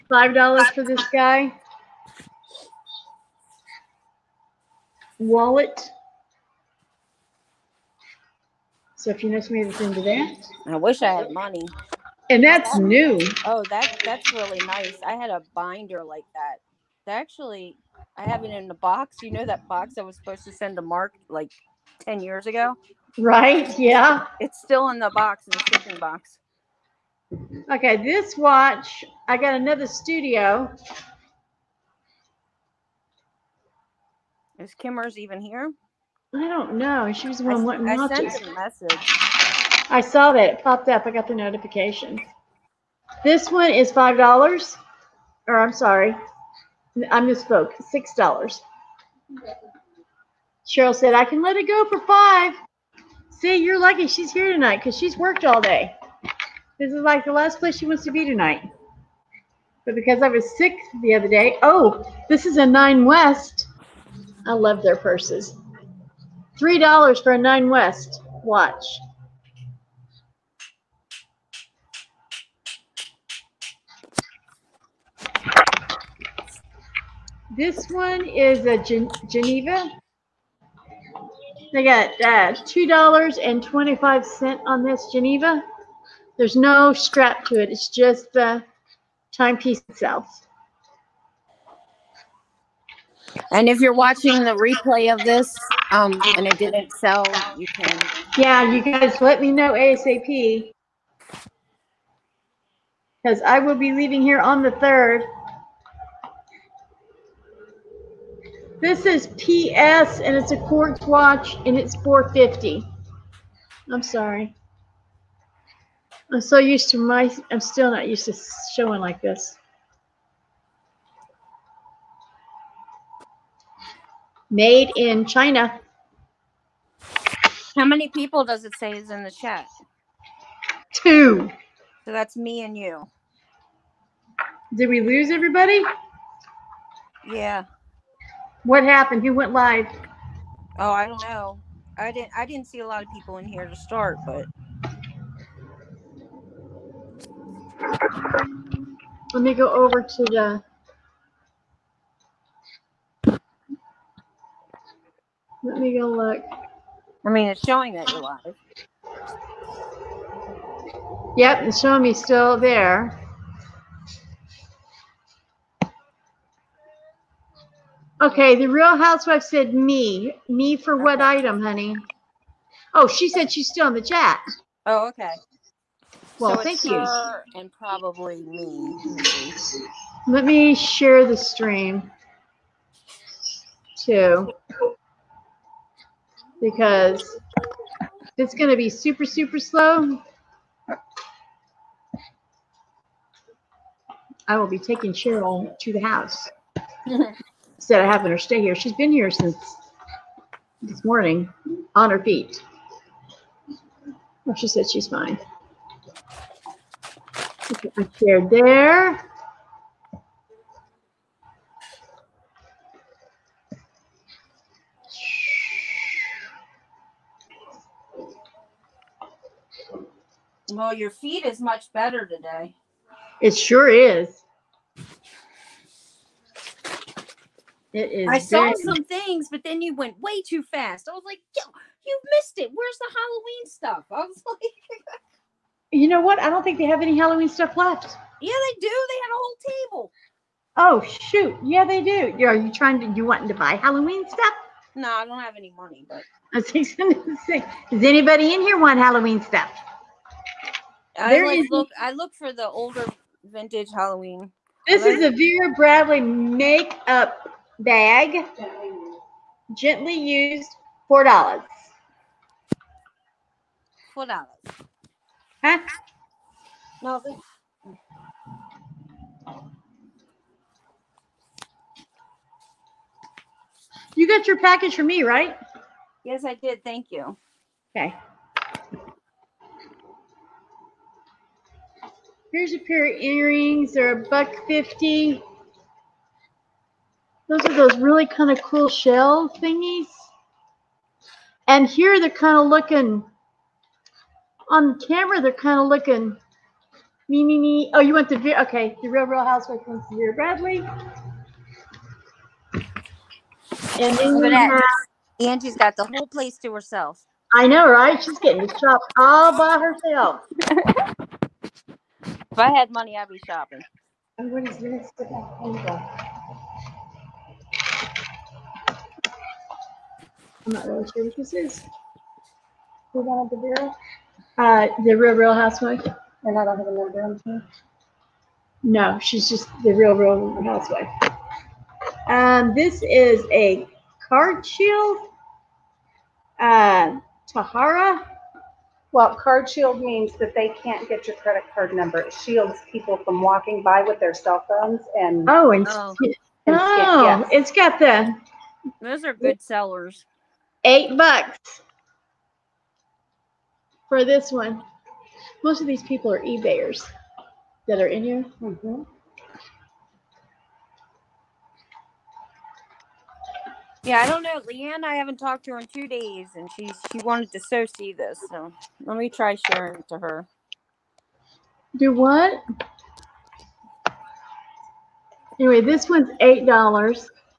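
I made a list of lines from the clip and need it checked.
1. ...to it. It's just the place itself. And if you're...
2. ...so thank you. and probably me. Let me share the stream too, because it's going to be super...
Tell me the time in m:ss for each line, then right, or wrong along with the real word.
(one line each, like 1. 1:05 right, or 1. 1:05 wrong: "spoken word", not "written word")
1. 1:27 wrong: "timepiece", not "place"
2. 2:56 right.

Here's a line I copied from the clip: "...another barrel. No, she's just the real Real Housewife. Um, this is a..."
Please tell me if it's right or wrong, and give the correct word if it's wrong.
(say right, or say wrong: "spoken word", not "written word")
right.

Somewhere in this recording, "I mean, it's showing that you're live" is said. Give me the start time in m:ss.
2:37.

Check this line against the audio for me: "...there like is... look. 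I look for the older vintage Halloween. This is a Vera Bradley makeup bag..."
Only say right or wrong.
right.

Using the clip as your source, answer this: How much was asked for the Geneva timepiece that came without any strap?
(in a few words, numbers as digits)
$2.25.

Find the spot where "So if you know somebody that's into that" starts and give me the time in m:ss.
0:08.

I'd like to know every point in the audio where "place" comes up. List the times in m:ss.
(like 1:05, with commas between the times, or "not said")
0:57, 5:06.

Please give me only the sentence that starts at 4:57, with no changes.
Oh, you went to, okay, the Real Real Housewife went to Bradley.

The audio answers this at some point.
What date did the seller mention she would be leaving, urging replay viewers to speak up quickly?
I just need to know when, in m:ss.
1:44.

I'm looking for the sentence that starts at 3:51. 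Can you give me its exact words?
I was like, yo, you missed it.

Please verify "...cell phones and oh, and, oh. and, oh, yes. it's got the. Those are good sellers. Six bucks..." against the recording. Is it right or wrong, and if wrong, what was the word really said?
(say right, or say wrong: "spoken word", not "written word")
wrong: "Eight", not "Six".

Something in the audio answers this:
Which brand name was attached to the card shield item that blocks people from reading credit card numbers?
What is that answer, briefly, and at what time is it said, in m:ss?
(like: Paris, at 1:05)
Tahari, at 5:37.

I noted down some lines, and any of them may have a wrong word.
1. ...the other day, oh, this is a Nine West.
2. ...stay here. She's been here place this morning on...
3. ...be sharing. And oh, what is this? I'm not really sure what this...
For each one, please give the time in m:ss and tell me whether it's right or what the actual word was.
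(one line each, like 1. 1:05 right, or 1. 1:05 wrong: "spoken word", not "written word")
1. 1:01 right
2. 3:18 wrong: "since", not "place"
3. 5:13 wrong: "shopping", not "sharing".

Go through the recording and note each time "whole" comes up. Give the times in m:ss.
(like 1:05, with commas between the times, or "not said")
3:59, 5:06.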